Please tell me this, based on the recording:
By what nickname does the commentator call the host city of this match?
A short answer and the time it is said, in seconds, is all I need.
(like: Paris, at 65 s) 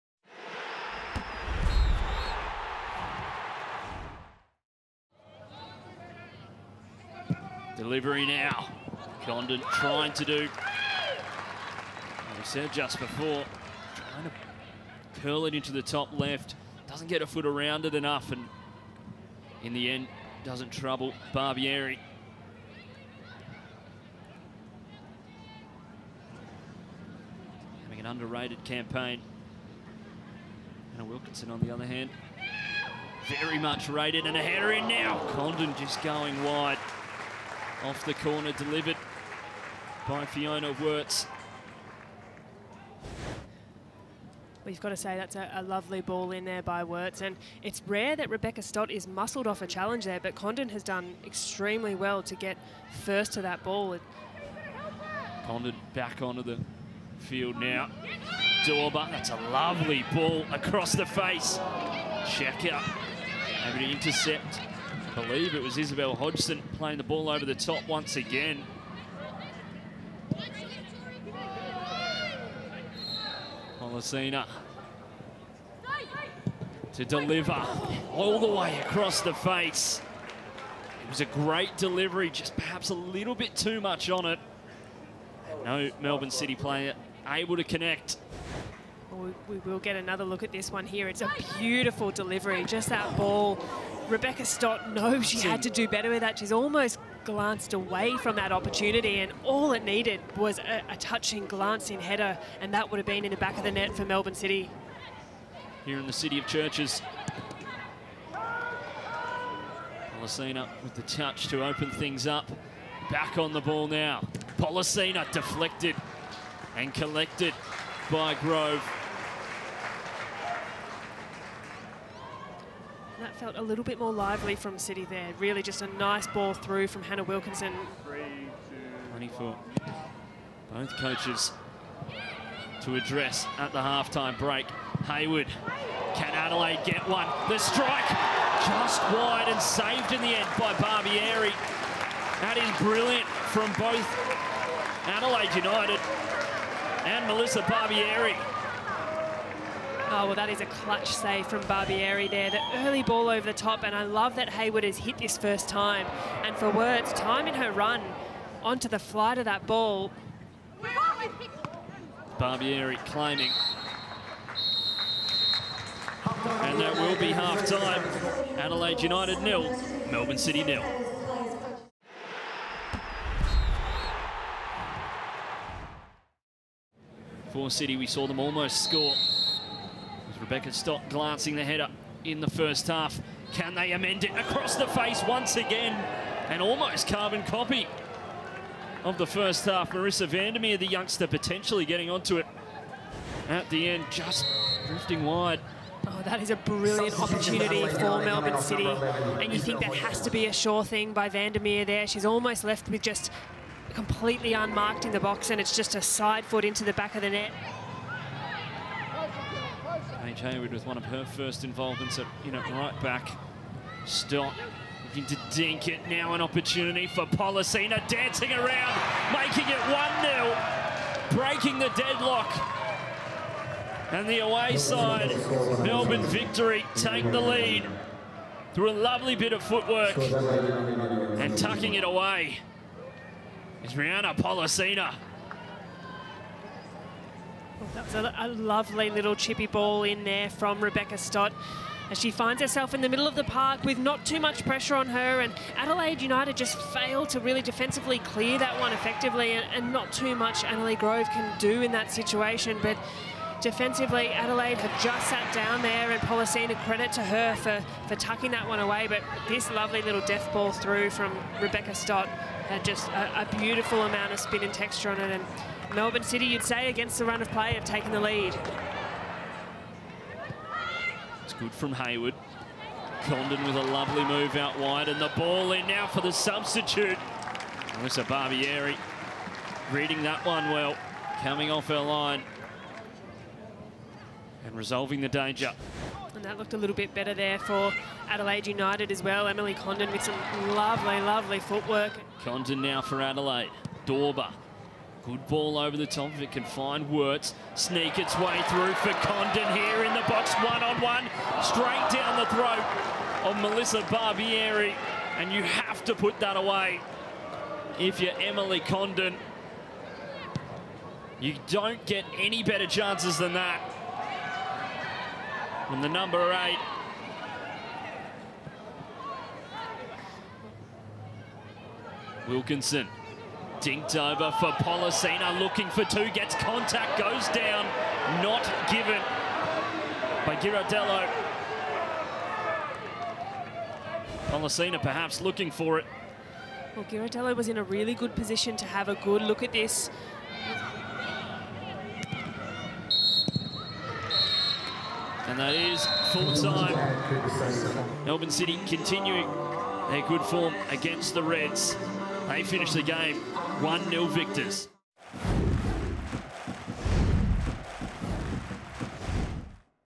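City of Churches, at 106 s.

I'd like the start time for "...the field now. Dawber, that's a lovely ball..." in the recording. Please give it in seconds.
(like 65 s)
56 s.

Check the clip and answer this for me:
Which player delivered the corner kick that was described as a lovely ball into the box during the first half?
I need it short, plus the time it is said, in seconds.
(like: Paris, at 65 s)
Fiona Worts, at 40 s.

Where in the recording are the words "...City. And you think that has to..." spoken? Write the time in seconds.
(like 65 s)
198 s.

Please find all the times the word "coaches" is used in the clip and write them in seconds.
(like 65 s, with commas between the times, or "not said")
130 s.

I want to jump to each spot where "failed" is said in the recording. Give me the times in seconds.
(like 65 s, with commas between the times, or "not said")
246 s.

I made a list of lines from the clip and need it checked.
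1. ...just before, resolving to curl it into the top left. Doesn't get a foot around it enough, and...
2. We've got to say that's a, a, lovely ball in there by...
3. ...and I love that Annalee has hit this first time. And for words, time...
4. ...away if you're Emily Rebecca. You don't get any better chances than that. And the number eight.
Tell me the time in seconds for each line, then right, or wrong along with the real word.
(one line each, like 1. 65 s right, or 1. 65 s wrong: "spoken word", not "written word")
1. 12 s wrong: "trying", not "resolving"
2. 44 s right
3. 153 s wrong: "Hayward", not "Annalee"
4. 306 s wrong: "Condon", not "Rebecca".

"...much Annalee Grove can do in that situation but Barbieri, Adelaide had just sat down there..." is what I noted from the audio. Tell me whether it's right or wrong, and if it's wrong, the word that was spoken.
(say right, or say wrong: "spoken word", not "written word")
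wrong: "Defensively", not "Barbieri".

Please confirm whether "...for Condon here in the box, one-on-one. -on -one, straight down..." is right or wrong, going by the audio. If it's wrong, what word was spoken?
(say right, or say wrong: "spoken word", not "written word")
right.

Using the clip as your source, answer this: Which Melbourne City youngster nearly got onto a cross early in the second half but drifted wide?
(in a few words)
Marissa Vandermeer.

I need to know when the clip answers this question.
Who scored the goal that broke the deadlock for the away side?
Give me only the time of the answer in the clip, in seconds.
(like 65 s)
233 s.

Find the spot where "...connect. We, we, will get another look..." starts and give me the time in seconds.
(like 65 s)
87 s.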